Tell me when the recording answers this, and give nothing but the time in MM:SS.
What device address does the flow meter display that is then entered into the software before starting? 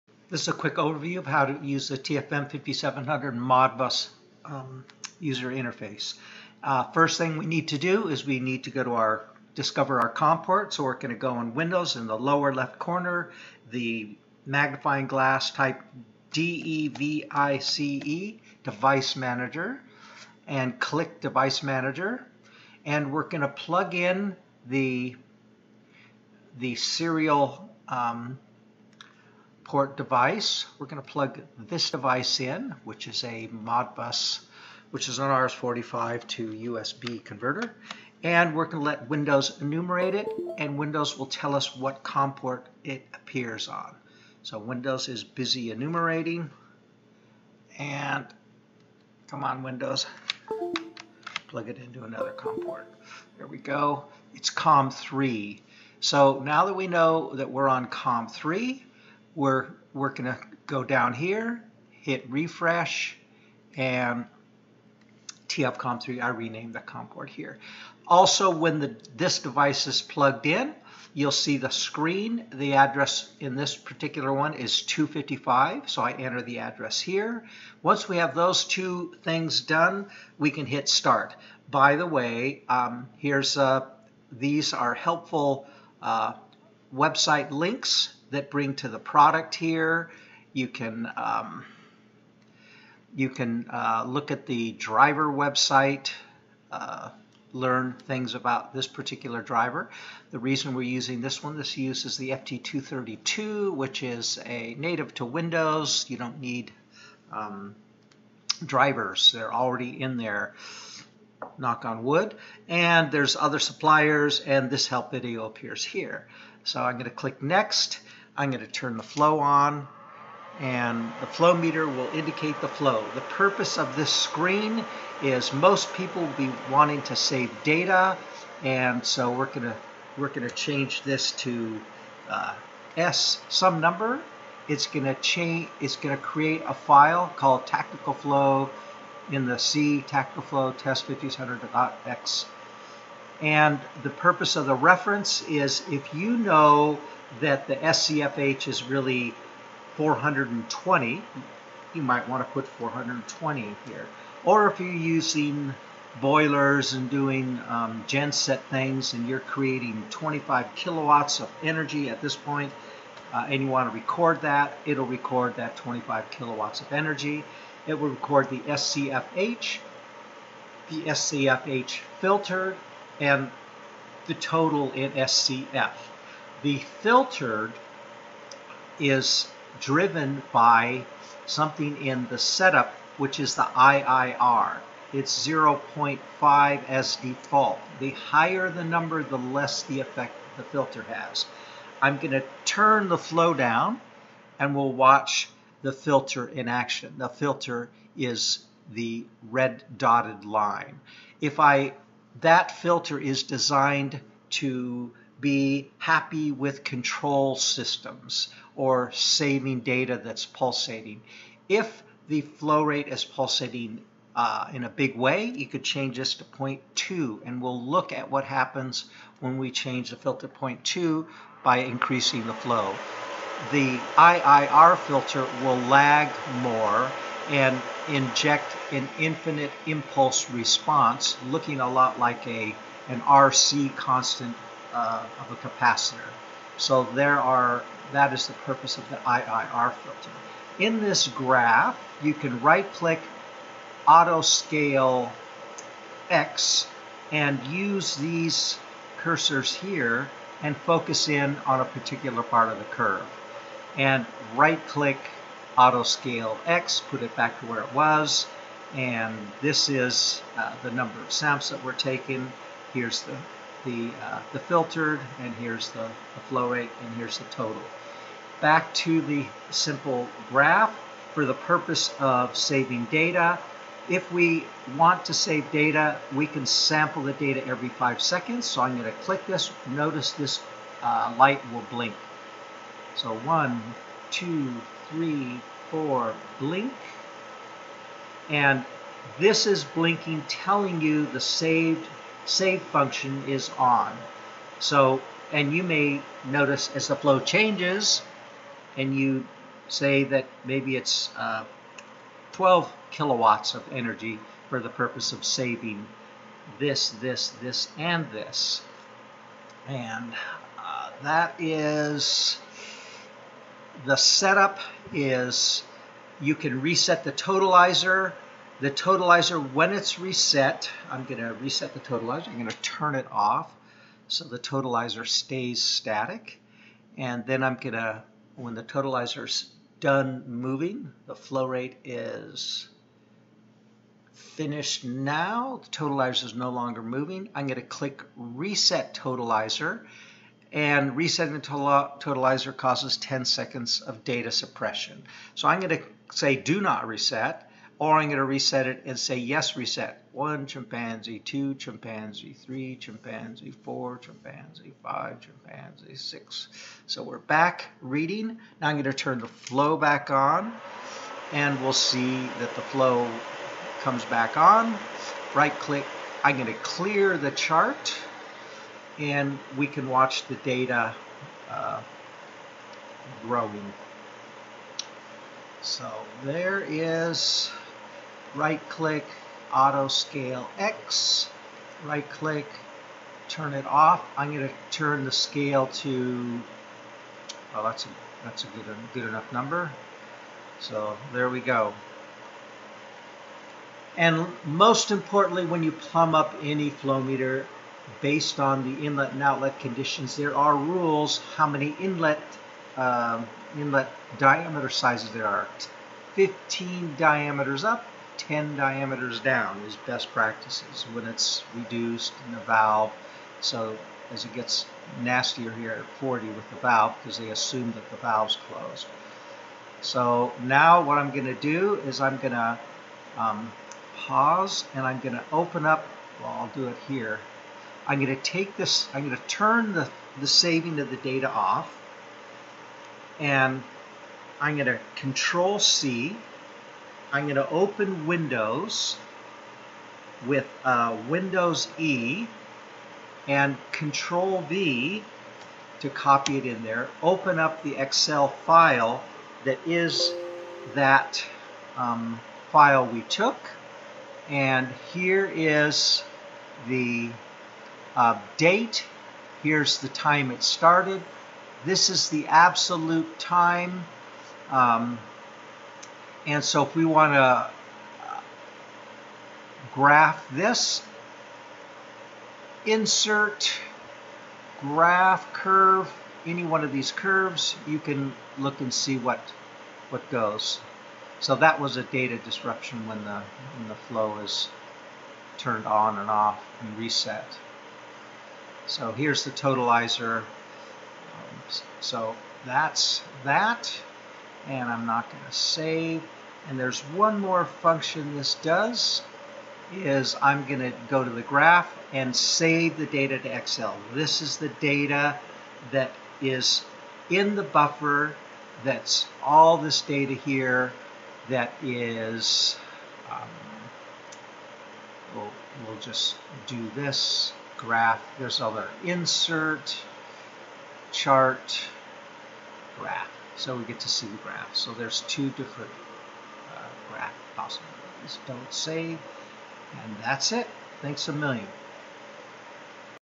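01:14.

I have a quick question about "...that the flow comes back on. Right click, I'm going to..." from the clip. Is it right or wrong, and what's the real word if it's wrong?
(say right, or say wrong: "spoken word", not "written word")
right.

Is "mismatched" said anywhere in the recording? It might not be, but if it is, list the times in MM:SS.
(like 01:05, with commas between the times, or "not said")
not said.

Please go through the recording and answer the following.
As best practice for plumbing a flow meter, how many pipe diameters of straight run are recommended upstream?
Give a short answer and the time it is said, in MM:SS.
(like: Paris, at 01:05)
15 diameters, at 06:46.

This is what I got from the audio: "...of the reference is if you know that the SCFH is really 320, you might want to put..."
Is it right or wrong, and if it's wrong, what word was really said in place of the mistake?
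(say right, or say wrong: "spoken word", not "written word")
wrong: "420", not "320".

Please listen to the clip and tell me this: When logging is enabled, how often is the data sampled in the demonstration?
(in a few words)
Every 5 seconds.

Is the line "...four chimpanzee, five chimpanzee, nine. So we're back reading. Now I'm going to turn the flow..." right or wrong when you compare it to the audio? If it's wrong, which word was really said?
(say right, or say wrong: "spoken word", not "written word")
wrong: "six", not "nine".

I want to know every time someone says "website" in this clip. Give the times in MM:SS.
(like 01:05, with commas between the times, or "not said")
01:26, 01:35.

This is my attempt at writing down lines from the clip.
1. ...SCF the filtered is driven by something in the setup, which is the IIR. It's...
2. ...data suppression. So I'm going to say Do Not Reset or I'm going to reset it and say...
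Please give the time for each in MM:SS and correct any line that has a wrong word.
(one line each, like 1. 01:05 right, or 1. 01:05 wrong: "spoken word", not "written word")
1. 02:55 right
2. 05:44 right.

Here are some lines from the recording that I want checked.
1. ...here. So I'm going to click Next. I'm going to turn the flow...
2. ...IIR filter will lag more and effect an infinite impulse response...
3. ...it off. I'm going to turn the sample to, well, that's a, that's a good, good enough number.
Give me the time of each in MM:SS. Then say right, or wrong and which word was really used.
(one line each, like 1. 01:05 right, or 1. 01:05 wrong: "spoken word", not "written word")
1. 01:55 right
2. 03:44 wrong: "inject", not "effect"
3. 06:23 wrong: "scale", not "sample".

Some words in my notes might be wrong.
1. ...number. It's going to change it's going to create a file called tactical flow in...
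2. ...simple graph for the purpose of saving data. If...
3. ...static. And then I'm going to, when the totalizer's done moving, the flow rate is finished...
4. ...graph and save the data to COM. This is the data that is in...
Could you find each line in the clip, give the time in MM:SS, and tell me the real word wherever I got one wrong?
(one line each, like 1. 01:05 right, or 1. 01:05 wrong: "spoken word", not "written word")
1. 02:13 right
2. 04:29 right
3. 05:25 right
4. 08:21 wrong: "Excel", not "COM".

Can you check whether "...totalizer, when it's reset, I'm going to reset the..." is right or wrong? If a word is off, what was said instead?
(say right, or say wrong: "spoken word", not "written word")
right.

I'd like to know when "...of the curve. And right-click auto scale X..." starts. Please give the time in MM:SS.
04:12.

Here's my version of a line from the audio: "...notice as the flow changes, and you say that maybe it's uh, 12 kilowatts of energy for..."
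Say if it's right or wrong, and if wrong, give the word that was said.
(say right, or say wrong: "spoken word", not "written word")
right.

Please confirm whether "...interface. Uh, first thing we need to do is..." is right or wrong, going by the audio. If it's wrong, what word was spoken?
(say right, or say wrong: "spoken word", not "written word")
right.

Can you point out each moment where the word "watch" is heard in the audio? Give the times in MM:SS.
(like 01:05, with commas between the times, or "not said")
03:14, 06:10.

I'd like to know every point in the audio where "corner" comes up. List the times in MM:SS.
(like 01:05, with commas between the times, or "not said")
00:12.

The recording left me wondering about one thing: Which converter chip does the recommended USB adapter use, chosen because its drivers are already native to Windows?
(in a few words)
FT232.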